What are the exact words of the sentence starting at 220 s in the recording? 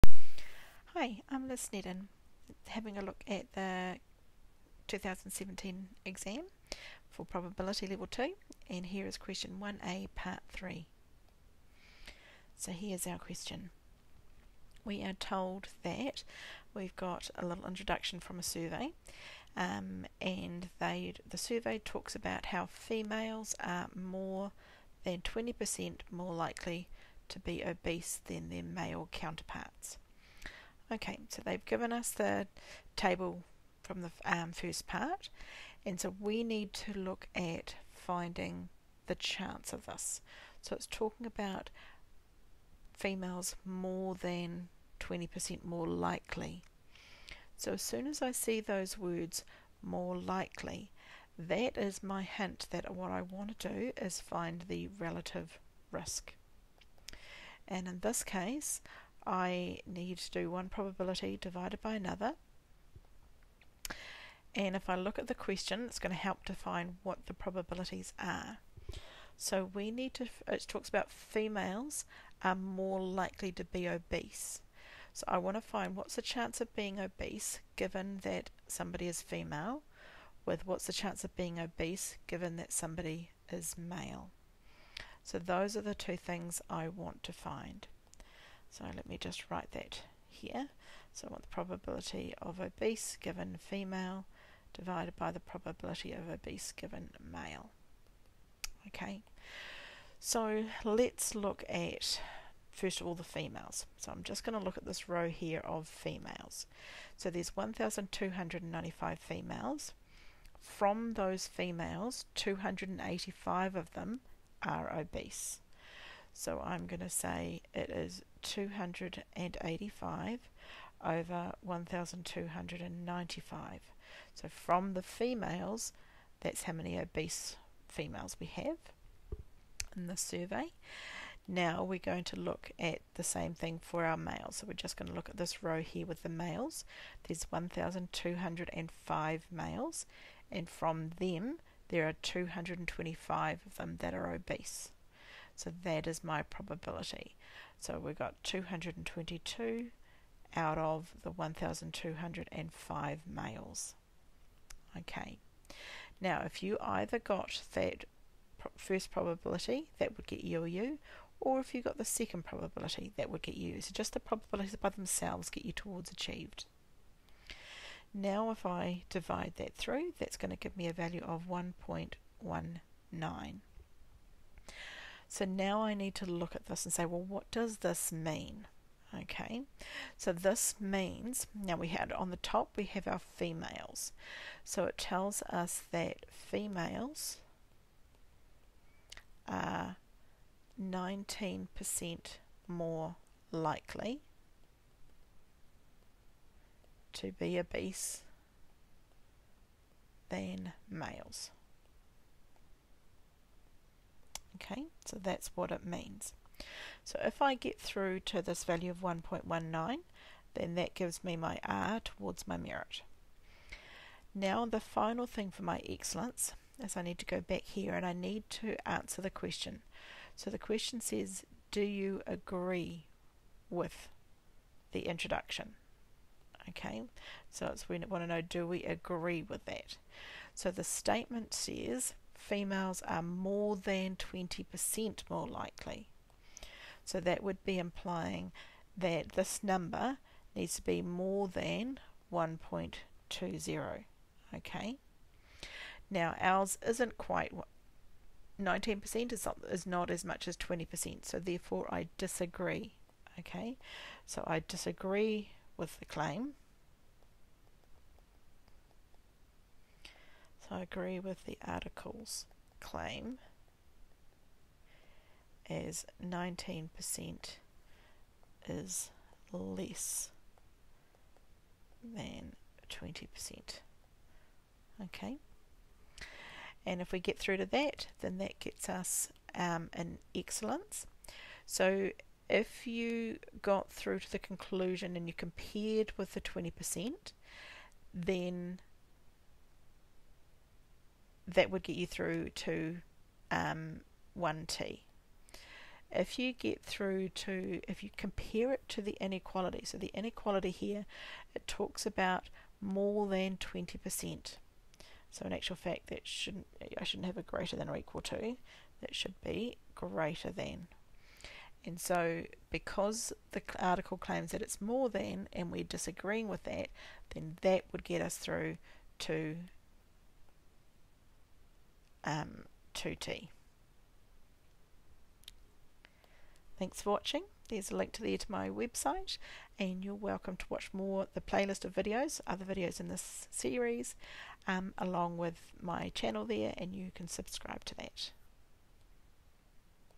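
So the question says, do you agree with the introduction?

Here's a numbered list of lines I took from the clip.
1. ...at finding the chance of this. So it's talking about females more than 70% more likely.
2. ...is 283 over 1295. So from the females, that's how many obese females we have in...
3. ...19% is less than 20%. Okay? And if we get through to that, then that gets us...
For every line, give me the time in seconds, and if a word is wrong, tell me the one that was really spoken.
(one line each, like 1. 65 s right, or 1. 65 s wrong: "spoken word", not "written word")
1. 37 s wrong: "20", not "70"
2. 117 s wrong: "285", not "283"
3. 266 s right.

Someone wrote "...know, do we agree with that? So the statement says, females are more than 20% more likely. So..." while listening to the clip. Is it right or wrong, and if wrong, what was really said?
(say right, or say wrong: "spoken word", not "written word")
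right.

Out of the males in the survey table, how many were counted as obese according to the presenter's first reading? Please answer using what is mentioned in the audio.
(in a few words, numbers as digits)
225.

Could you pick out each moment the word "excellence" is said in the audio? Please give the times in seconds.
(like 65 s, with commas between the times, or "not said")
215 s, 280 s.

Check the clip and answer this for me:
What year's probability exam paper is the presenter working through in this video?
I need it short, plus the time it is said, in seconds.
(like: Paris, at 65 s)
2017, at 4 s.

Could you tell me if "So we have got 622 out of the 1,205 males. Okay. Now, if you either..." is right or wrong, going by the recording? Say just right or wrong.
wrong.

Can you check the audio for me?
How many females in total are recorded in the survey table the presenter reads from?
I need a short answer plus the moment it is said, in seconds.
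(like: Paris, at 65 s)
1,295, at 107 s.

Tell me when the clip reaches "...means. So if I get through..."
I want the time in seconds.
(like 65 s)
205 s.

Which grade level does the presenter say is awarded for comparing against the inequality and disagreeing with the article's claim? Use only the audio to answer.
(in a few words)
2t.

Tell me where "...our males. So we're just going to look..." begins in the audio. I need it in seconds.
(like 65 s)
134 s.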